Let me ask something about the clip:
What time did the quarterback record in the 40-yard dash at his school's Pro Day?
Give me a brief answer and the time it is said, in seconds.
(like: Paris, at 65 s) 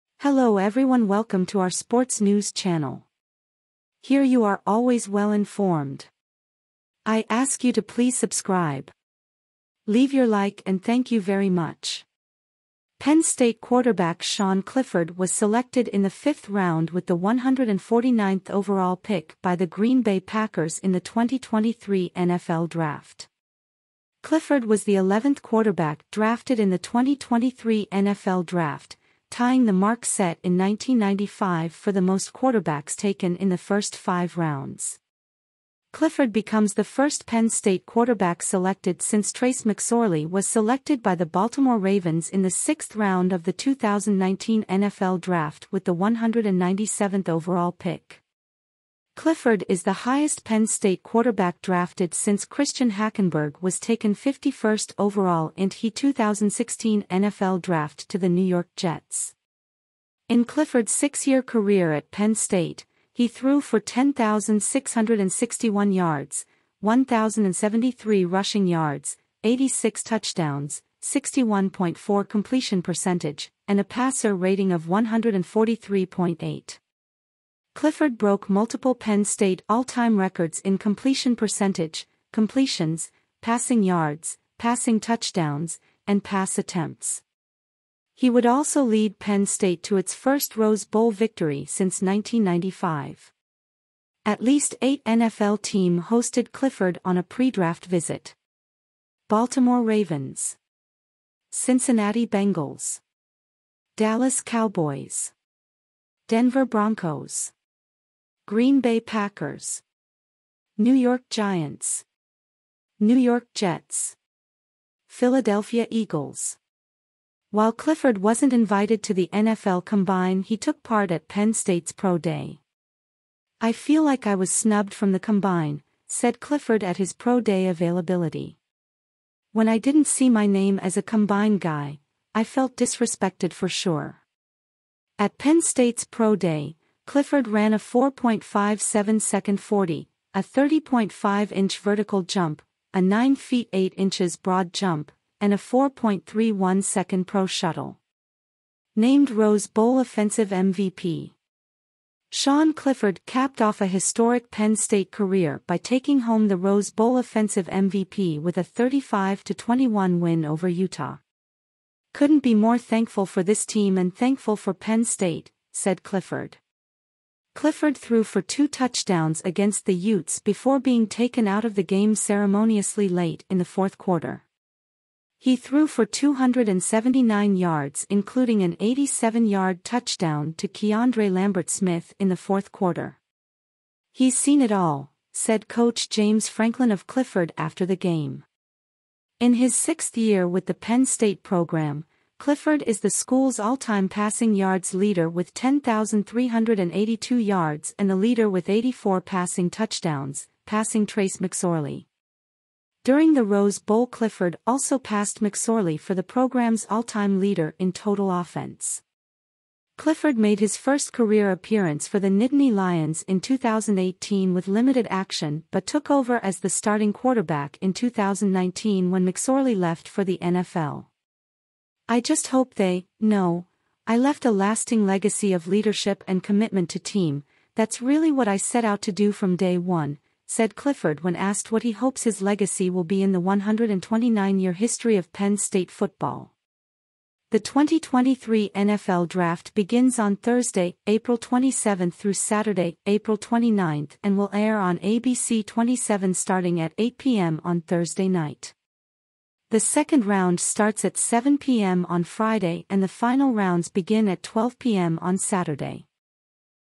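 4.57 seconds, at 137 s.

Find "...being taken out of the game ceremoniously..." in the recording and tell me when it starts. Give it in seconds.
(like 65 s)
170 s.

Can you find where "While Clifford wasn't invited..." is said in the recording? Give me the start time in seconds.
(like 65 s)
117 s.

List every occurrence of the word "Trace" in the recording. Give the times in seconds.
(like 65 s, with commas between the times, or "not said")
39 s, 201 s.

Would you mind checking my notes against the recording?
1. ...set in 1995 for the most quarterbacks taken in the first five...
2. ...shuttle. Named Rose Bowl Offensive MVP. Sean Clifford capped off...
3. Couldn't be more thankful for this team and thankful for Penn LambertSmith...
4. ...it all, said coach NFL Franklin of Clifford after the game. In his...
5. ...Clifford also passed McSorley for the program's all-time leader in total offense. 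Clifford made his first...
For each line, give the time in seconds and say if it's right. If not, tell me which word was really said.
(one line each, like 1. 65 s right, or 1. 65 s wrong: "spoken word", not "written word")
1. 30 s right
2. 147 s right
3. 162 s wrong: "State", not "LambertSmith"
4. 184 s wrong: "James", not "NFL"
5. 204 s right.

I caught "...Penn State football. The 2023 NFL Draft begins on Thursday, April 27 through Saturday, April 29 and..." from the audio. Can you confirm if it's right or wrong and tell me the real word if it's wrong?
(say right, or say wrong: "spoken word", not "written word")
right.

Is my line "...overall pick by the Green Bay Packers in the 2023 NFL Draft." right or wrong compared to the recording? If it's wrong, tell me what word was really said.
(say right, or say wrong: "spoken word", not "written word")
right.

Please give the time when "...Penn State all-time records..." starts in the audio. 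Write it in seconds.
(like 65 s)
78 s.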